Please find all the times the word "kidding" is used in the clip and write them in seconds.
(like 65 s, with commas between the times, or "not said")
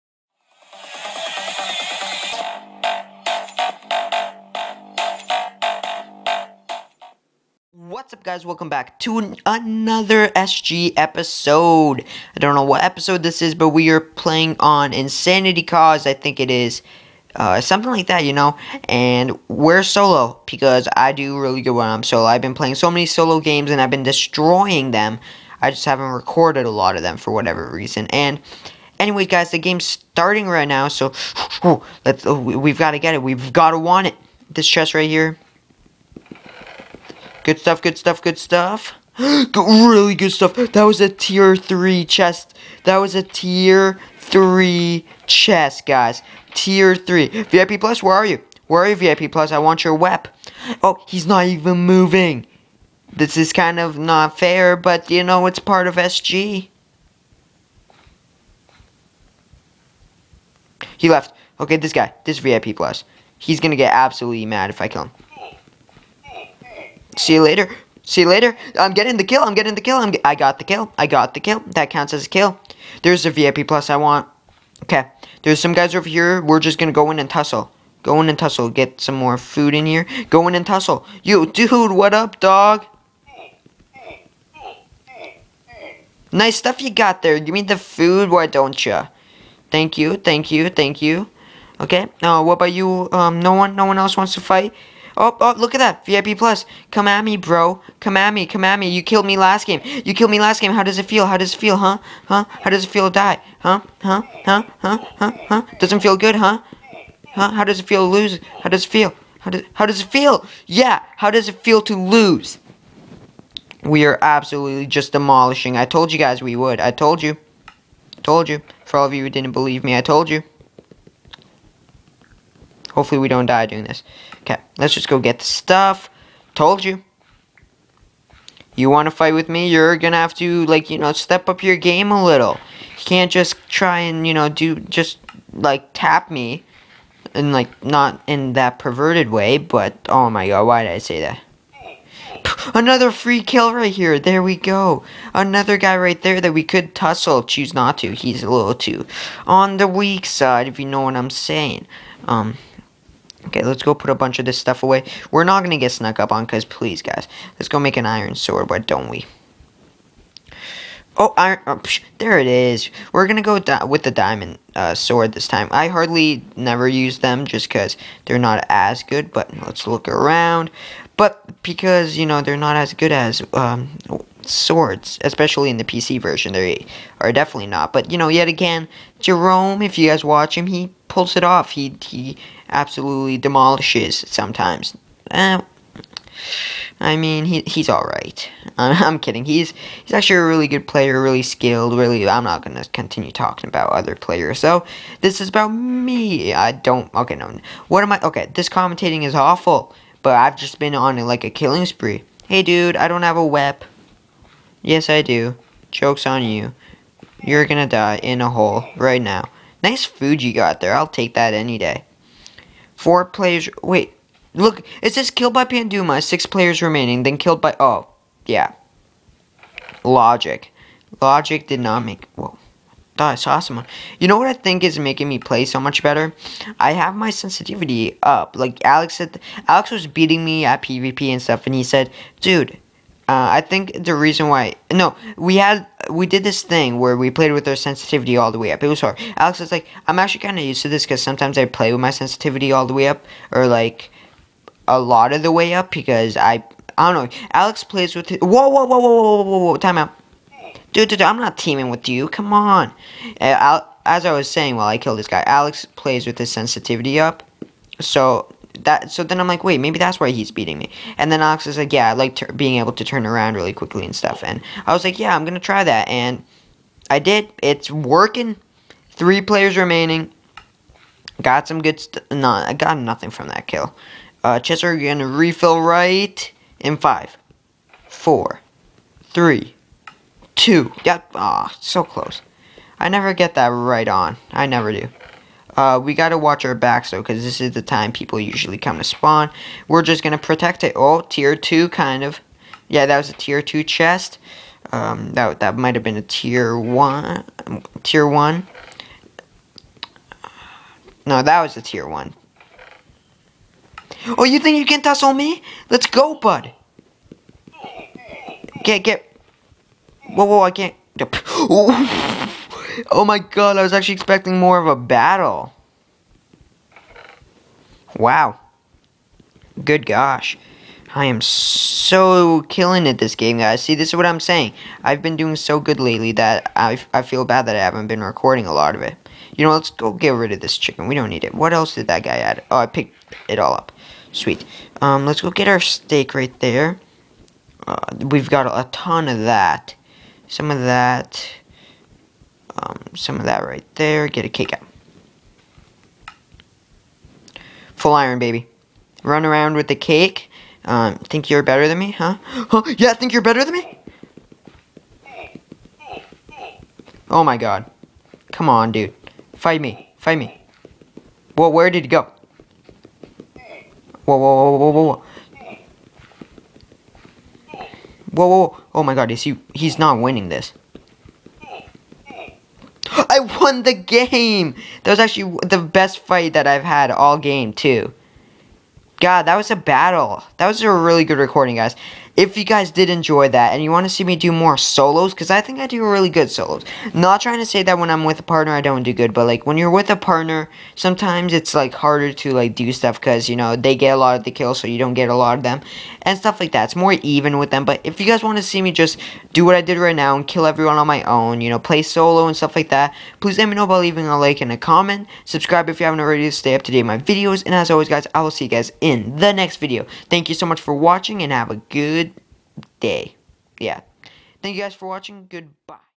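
189 s.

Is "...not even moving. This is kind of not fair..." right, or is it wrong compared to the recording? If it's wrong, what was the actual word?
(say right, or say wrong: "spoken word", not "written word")
right.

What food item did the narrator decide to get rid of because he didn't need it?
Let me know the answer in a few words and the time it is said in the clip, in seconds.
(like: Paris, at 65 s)
Chicken, at 330 s.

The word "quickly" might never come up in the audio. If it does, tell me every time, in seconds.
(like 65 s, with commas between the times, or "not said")
263 s.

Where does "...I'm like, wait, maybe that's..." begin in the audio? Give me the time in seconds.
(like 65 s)
259 s.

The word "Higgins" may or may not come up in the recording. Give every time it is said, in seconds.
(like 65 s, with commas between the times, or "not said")
not said.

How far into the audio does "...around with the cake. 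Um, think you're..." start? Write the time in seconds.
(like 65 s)
349 s.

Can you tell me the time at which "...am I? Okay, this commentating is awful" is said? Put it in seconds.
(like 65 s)
198 s.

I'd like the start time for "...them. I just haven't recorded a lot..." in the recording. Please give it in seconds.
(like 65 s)
24 s.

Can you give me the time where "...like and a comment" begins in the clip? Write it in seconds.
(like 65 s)
404 s.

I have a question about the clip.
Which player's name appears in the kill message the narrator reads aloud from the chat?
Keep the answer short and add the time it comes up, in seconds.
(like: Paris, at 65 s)
Panduma, at 215 s.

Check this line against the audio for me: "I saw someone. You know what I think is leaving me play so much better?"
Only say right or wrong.
wrong.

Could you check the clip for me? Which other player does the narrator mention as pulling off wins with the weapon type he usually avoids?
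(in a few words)
Jerome.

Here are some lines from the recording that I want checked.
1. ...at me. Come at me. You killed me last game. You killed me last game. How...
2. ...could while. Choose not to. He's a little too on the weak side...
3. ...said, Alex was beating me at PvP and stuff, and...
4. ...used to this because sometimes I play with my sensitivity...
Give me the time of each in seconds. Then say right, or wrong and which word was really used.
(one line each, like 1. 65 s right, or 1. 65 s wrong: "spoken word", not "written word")
1. 98 s right
2. 146 s wrong: "tussle", not "while"
3. 229 s right
4. 240 s right.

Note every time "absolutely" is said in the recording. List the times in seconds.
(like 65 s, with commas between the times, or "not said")
63 s, 114 s, 182 s.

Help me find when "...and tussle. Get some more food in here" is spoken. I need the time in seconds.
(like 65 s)
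78 s.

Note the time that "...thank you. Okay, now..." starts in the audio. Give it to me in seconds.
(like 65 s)
90 s.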